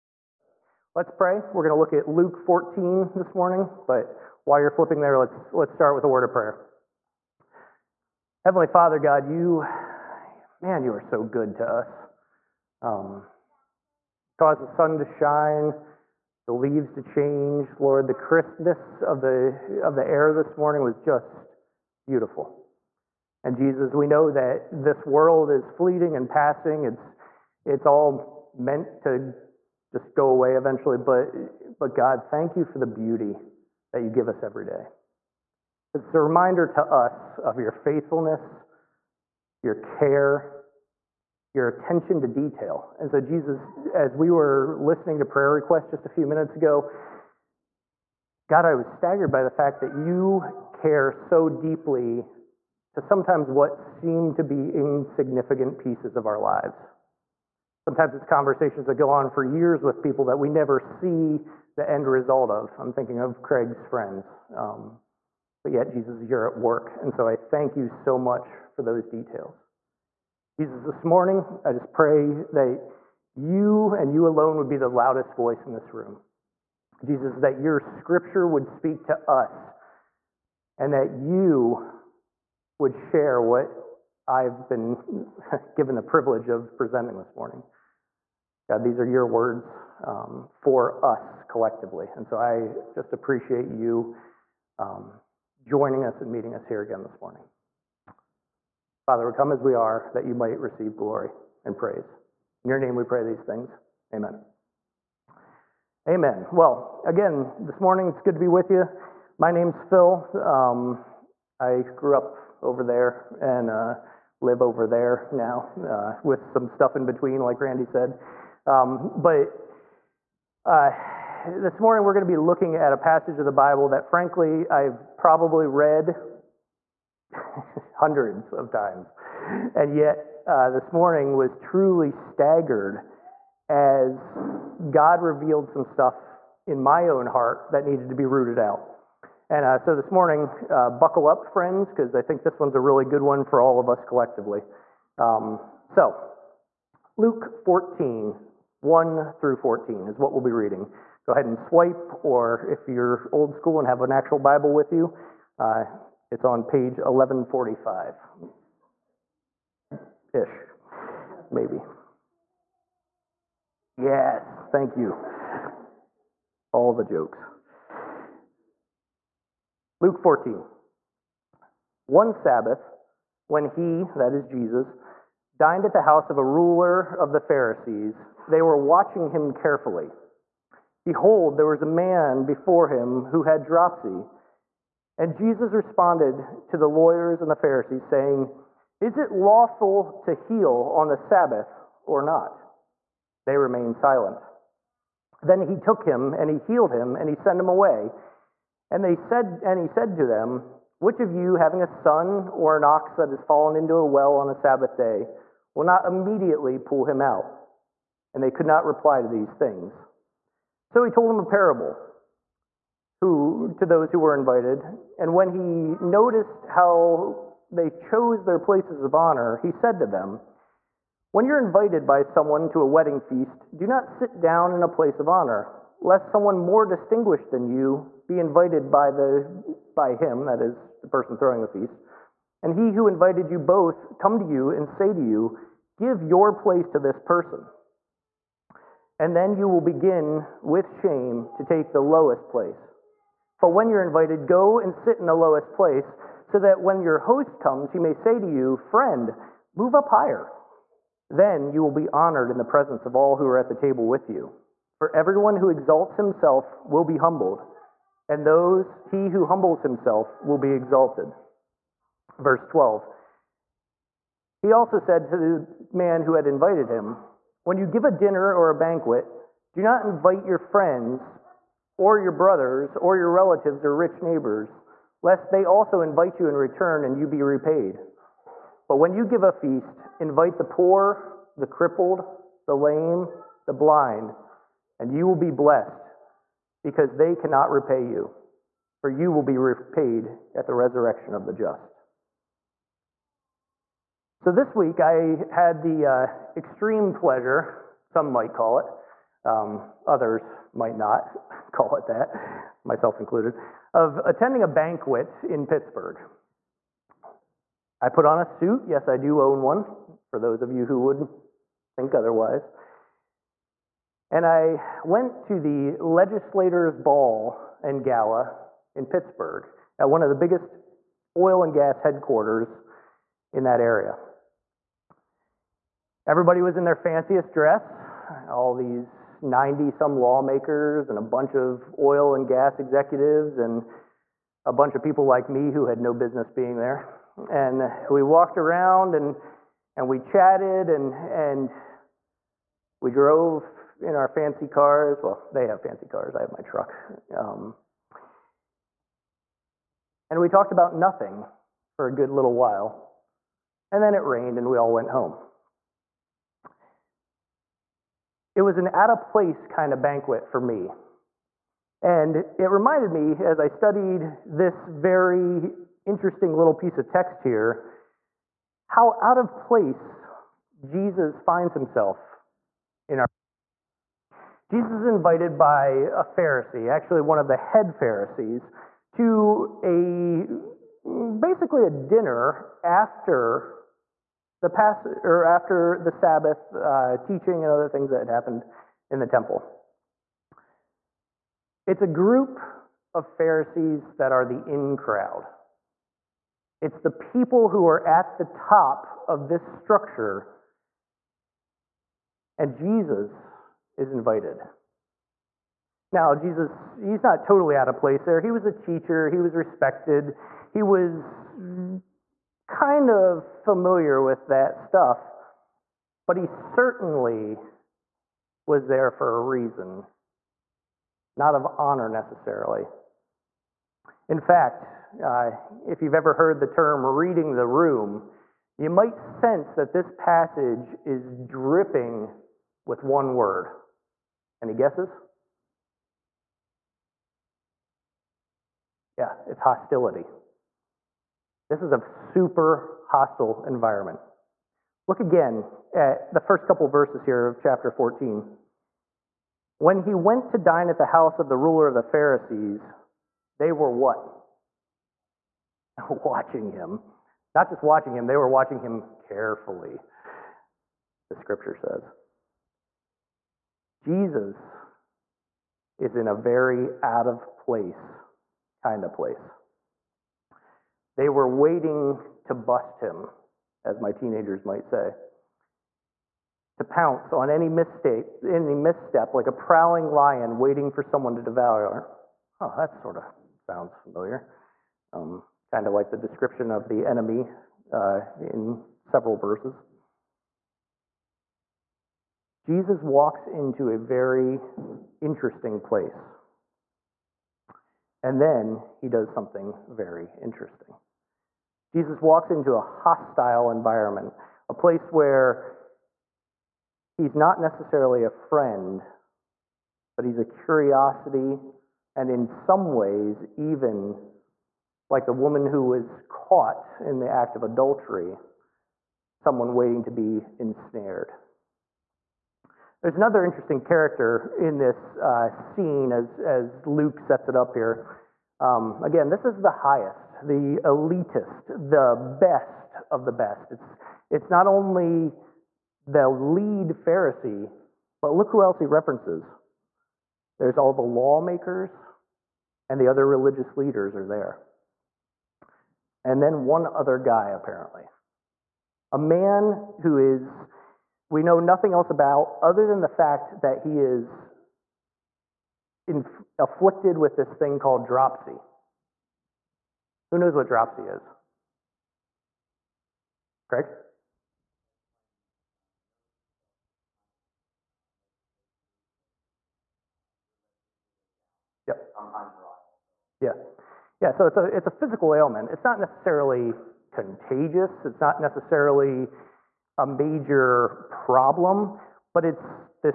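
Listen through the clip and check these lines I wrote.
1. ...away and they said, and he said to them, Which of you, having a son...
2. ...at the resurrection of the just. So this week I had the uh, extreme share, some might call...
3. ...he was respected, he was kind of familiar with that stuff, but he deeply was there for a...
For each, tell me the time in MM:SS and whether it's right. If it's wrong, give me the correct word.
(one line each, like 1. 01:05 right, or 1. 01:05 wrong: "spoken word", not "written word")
1. 03:17 right
2. 04:50 wrong: "pleasure", not "share"
3. 06:49 wrong: "certainly", not "deeply".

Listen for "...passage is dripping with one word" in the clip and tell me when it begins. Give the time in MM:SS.
07:10.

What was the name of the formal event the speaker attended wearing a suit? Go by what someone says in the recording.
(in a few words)
Legislators Ball and Gala.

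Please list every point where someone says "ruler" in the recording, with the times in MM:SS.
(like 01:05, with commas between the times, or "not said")
02:56, 07:31.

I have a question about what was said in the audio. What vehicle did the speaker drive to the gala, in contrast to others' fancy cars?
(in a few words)
truck.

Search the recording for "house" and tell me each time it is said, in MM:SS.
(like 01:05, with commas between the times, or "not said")
02:56, 07:31.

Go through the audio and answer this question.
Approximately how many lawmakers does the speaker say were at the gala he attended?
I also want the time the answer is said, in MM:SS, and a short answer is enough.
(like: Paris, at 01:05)
90 some, at 05:29.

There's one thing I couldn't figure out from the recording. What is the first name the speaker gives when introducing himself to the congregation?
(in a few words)
Phil.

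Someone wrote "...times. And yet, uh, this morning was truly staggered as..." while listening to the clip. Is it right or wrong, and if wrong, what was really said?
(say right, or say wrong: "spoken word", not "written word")
right.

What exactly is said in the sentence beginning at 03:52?
And he who invited you both come to you and say to you, Give your place to this person.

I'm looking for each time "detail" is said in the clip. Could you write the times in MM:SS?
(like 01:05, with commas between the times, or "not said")
00:42, 01:09.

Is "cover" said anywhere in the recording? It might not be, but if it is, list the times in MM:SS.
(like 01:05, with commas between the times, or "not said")
not said.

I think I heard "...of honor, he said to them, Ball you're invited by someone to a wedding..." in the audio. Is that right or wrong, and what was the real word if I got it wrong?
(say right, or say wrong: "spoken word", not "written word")
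wrong: "When", not "Ball".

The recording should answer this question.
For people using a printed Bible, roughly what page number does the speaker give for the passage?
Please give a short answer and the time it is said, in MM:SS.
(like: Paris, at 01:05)
1145, at 02:36.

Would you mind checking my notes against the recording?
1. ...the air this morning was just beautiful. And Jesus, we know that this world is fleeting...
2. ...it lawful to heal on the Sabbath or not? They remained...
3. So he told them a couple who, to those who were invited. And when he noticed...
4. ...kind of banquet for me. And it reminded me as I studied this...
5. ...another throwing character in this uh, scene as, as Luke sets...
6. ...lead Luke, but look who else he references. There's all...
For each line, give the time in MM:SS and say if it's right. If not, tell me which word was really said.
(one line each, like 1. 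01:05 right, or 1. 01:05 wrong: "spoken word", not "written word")
1. 00:19 right
2. 03:09 right
3. 03:30 wrong: "parable", not "couple"
4. 05:59 right
5. 08:43 wrong: "interesting", not "throwing"
6. 08:56 wrong: "Pharisee", not "Luke".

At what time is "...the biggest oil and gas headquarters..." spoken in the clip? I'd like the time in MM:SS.
05:20.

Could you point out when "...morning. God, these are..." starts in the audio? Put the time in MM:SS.
01:27.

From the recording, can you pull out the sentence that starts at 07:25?
Look again at the first couple verses here of chapter 14.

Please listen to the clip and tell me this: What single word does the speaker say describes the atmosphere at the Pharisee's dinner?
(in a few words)
hostility.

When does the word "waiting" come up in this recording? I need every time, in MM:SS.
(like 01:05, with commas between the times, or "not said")
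07:51, 08:00, 08:39.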